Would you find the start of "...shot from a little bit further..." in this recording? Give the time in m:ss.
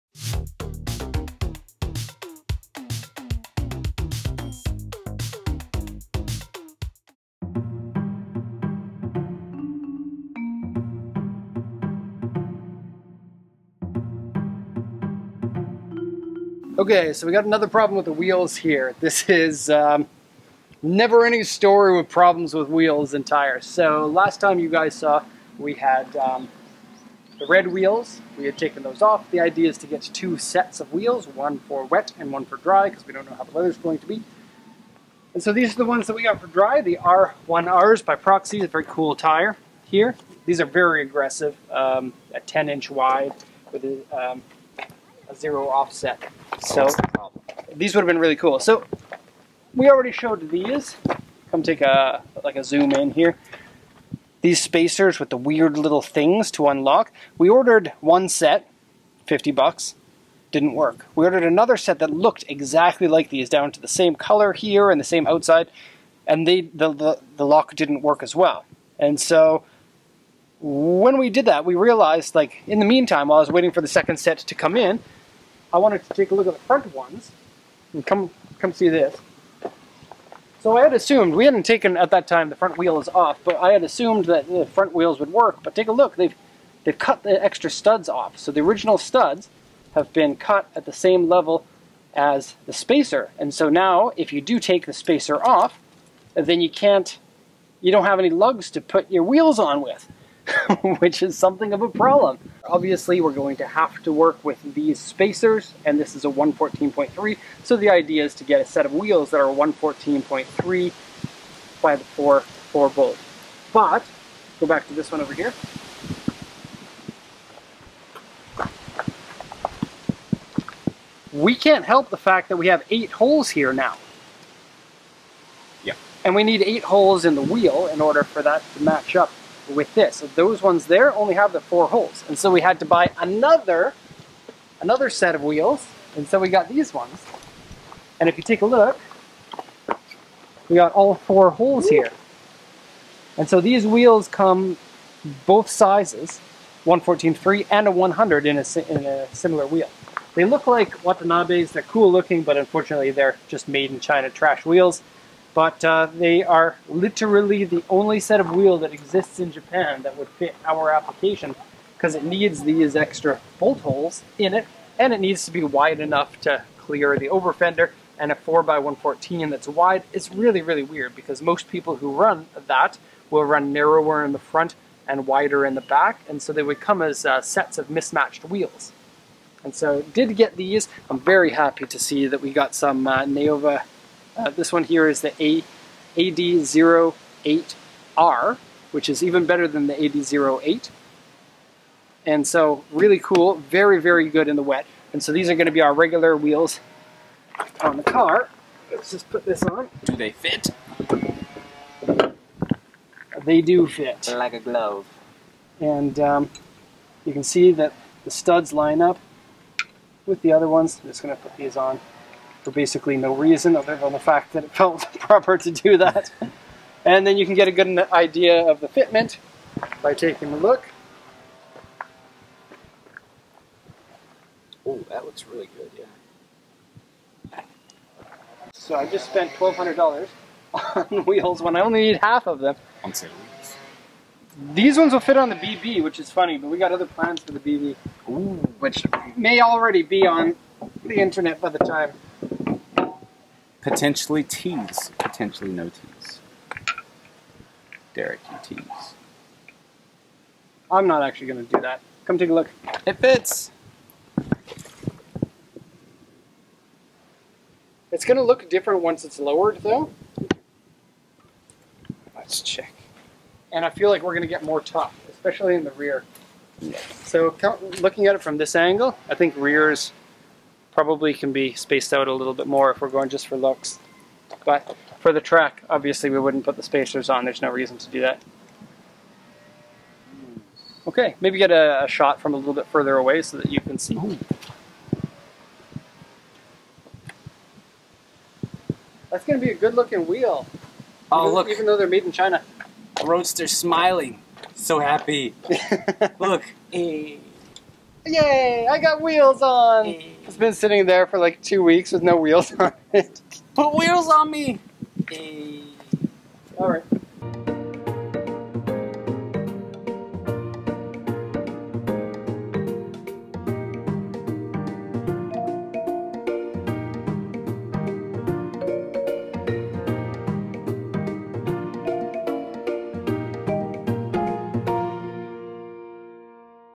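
4:42.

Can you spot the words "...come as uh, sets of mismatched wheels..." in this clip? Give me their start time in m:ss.
2:56.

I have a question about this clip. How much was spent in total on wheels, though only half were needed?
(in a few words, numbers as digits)
$1,200.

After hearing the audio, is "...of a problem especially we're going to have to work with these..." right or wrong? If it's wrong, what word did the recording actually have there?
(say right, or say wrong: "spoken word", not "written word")
wrong: "obviously", not "especially".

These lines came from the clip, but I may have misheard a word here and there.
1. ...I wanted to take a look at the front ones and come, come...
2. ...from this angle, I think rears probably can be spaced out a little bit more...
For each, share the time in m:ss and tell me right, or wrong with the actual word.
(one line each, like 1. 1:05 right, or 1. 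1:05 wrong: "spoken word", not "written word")
1. 1:15 right
2. 4:28 right.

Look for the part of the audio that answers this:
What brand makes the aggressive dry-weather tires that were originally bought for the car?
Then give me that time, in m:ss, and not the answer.
0:38.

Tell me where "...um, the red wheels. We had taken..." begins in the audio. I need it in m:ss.
0:26.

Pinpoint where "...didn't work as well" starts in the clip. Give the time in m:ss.
1:07.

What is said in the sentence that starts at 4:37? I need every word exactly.
There's no reason to do that.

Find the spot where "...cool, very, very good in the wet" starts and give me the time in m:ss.
3:13.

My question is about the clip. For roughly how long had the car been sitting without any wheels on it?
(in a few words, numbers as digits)
two weeks.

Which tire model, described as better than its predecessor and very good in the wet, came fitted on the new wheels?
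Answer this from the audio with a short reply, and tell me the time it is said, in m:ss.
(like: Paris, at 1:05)
AD08R, at 3:06.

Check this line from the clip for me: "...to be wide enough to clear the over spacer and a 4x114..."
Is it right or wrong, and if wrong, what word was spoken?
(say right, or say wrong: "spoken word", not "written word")
wrong: "fender", not "spacer".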